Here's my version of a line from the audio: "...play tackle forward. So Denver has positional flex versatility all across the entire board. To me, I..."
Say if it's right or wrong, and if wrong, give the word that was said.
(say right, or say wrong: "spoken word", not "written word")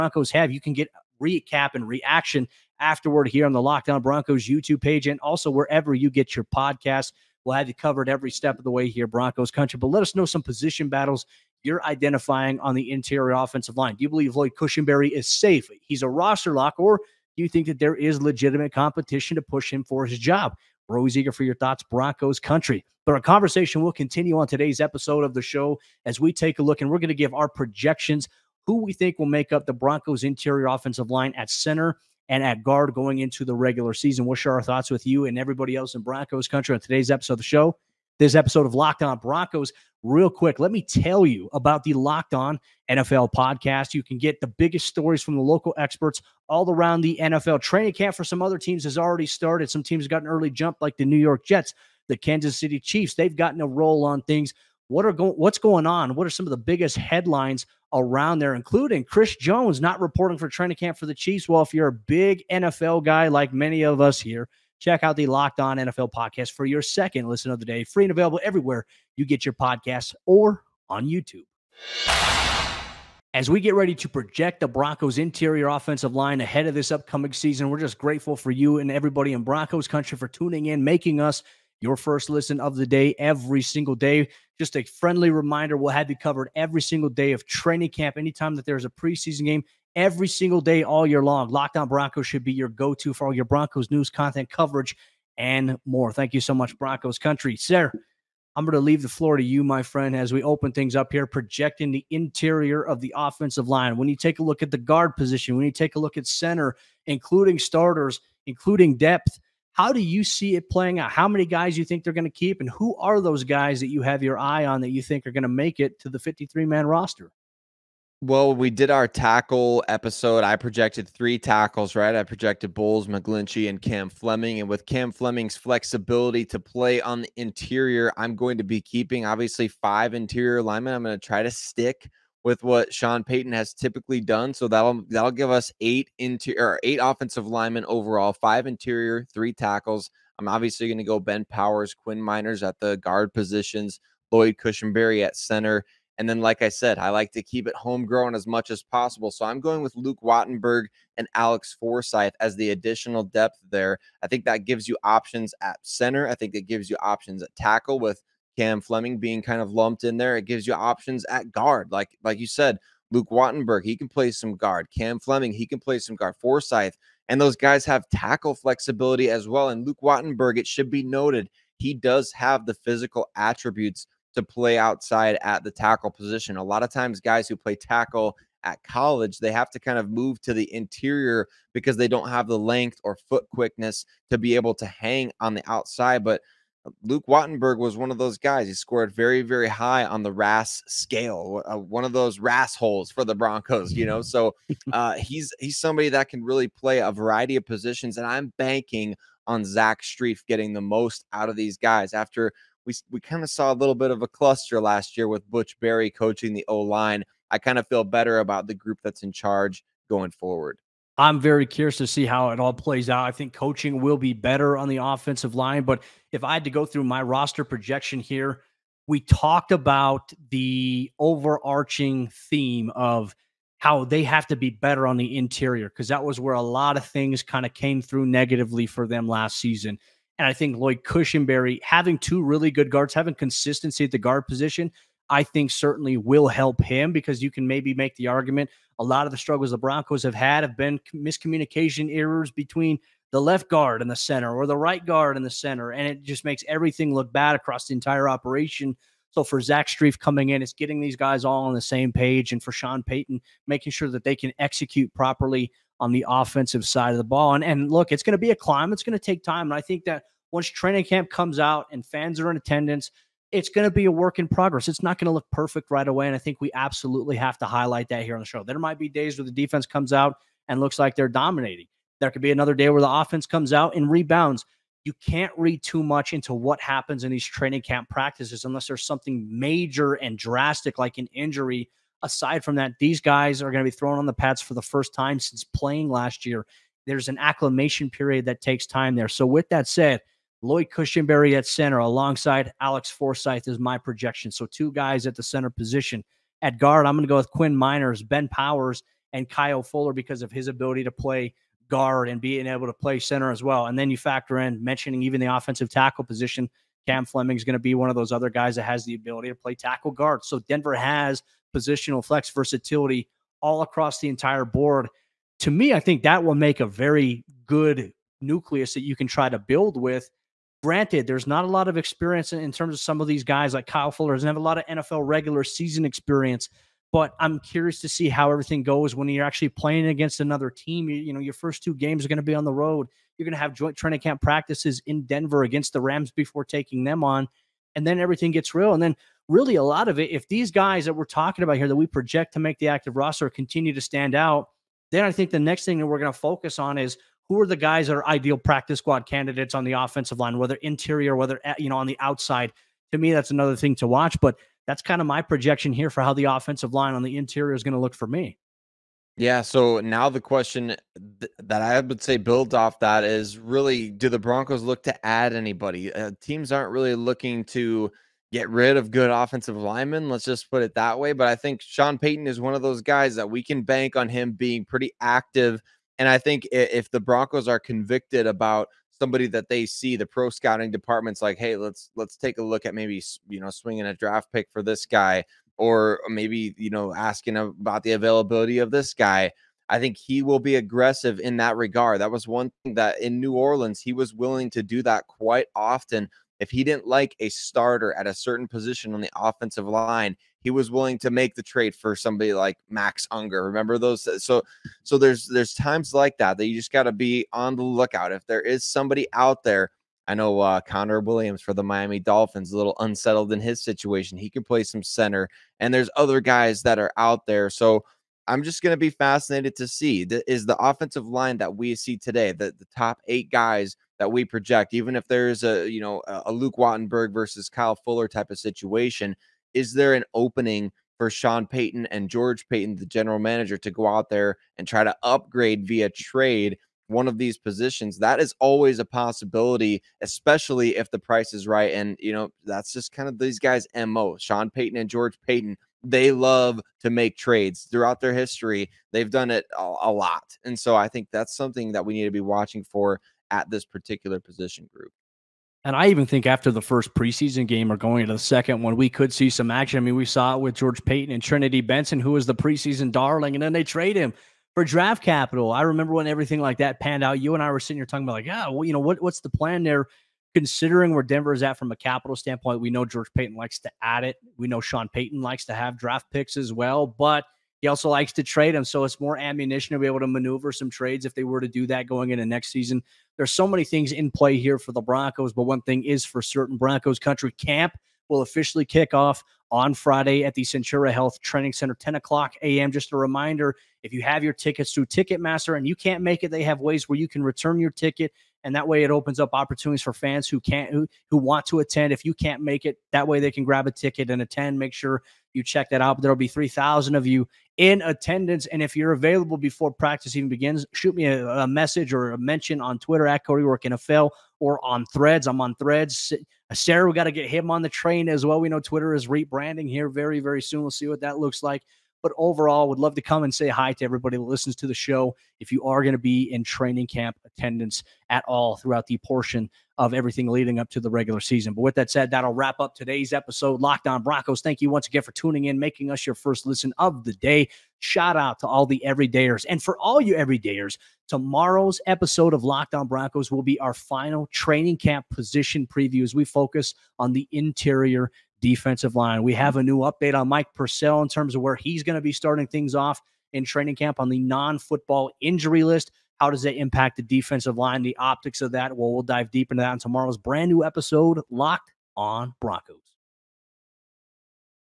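wrong: "guard", not "forward".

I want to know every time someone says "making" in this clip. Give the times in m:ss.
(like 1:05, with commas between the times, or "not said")
1:20, 4:13, 8:55.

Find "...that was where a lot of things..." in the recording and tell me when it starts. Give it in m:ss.
3:46.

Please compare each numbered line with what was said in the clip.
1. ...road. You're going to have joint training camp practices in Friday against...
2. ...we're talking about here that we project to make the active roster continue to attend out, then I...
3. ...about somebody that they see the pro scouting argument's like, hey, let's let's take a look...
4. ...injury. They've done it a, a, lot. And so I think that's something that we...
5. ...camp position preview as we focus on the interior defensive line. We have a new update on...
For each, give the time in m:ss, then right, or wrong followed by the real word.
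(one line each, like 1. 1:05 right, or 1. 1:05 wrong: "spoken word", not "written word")
1. 5:32 wrong: "Denver", not "Friday"
2. 5:41 wrong: "stand", not "attend"
3. 6:18 wrong: "department", not "argument"
4. 7:28 wrong: "history", not "injury"
5. 9:04 right.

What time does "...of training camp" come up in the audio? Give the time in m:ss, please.
1:27.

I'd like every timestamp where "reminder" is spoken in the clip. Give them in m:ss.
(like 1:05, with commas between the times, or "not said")
1:25, 8:13.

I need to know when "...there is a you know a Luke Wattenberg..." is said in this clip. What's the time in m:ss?
7:05.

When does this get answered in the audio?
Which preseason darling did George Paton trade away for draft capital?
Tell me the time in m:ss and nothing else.
7:41.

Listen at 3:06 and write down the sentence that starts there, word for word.
But uh, Luke Wattenberg was one of those guys.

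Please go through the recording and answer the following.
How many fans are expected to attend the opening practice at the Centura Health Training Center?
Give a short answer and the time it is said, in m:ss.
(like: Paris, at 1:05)
3,000, at 8:26.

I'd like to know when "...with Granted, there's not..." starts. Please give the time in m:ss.
5:19.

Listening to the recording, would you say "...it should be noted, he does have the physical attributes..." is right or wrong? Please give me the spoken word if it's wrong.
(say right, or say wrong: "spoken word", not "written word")
right.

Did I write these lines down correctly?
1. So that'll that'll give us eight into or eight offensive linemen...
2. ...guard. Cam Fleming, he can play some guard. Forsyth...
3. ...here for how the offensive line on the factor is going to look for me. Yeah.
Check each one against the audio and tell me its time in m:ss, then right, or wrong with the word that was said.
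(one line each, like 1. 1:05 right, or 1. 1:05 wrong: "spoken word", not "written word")
1. 2:14 right
2. 2:44 right
3. 5:55 wrong: "interior", not "factor".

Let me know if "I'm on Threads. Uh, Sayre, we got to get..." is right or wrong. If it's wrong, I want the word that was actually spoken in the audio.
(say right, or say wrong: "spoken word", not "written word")
right.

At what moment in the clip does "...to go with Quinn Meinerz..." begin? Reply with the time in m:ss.
4:57.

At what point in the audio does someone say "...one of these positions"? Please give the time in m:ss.
7:17.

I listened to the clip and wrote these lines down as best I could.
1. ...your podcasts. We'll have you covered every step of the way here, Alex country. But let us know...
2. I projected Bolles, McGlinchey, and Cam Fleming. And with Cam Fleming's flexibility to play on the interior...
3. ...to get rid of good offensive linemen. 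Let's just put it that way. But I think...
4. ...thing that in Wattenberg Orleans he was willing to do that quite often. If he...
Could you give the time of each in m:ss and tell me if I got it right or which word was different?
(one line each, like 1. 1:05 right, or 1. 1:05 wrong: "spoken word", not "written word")
1. 0:06 wrong: "Broncos", not "Alex"
2. 2:02 right
3. 6:07 right
4. 6:32 wrong: "New", not "Wattenberg".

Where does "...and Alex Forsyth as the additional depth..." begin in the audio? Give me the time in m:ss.
2:31.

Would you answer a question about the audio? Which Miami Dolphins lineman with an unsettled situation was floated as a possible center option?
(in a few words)
Connor Williams.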